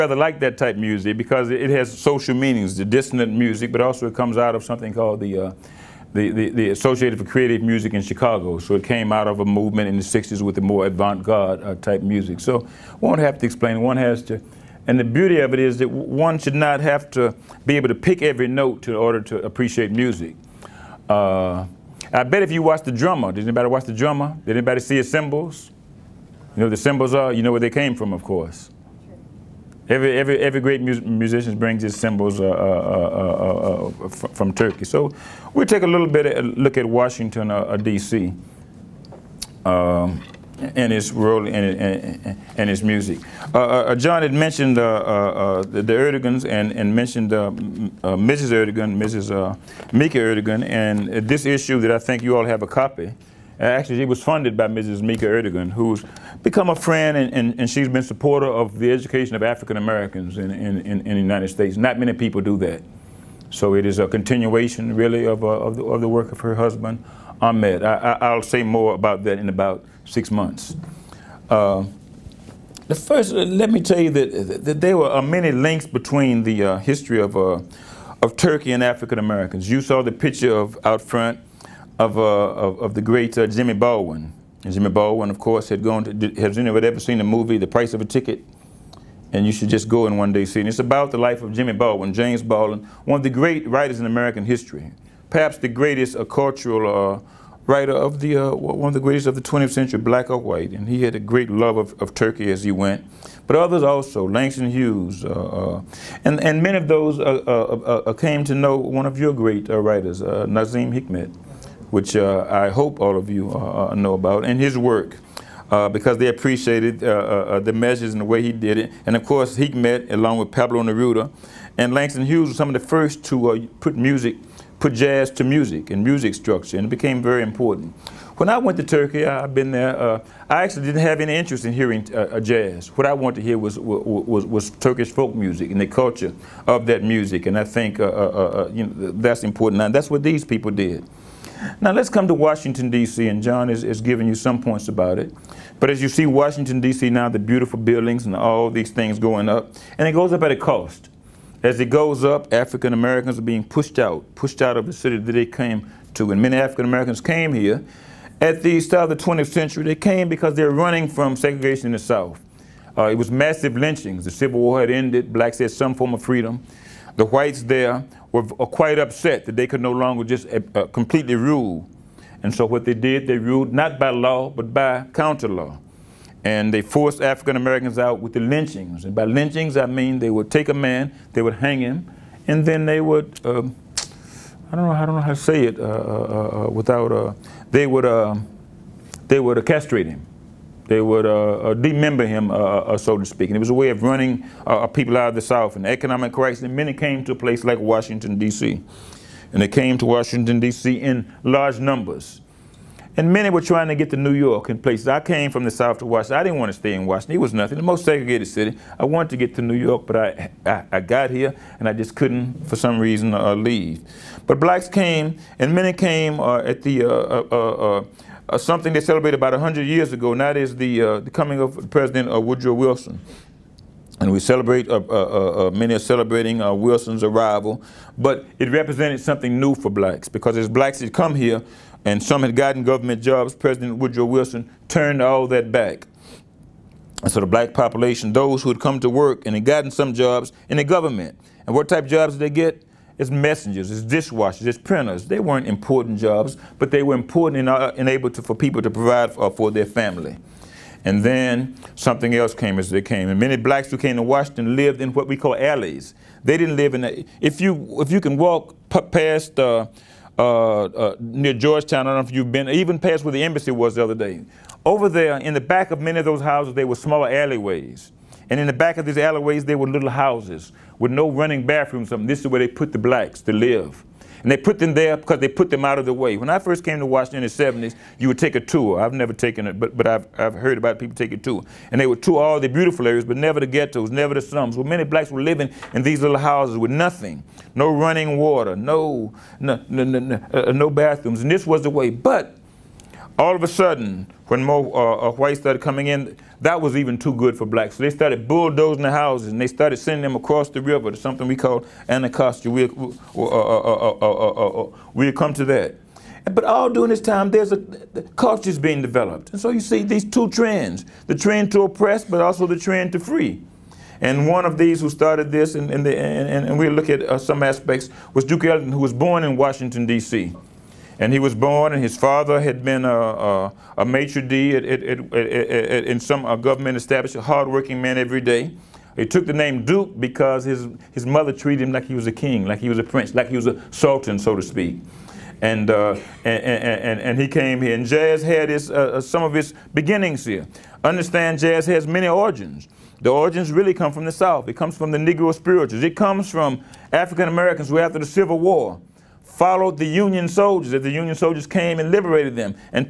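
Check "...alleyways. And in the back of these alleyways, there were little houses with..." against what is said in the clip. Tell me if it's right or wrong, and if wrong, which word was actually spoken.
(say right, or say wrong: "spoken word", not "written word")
right.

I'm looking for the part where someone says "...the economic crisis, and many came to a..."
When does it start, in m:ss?
3:15.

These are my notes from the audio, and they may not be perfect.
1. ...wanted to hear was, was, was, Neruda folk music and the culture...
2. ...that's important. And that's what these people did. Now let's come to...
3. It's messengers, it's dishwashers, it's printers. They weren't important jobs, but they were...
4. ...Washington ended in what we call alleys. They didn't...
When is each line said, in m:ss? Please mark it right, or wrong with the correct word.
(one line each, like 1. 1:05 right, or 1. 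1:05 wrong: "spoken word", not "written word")
1. 2:13 wrong: "Turkish", not "Neruda"
2. 2:19 right
3. 4:03 right
4. 4:14 wrong: "lived", not "ended".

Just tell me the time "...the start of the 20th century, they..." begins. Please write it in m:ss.
2:38.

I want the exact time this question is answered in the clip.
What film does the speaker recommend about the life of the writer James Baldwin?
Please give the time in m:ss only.
1:27.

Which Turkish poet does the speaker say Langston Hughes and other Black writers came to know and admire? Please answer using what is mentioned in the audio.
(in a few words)
Nazim Hikmet.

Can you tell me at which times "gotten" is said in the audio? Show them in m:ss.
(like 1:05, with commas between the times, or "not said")
3:52, 3:59.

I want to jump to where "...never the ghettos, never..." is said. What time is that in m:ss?
4:43.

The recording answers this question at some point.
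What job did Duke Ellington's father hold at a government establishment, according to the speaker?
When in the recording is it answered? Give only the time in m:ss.
5:24.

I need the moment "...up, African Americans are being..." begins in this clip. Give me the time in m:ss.
2:32.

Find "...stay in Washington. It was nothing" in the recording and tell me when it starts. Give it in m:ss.
3:26.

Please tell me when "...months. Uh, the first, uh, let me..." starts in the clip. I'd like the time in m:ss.
1:10.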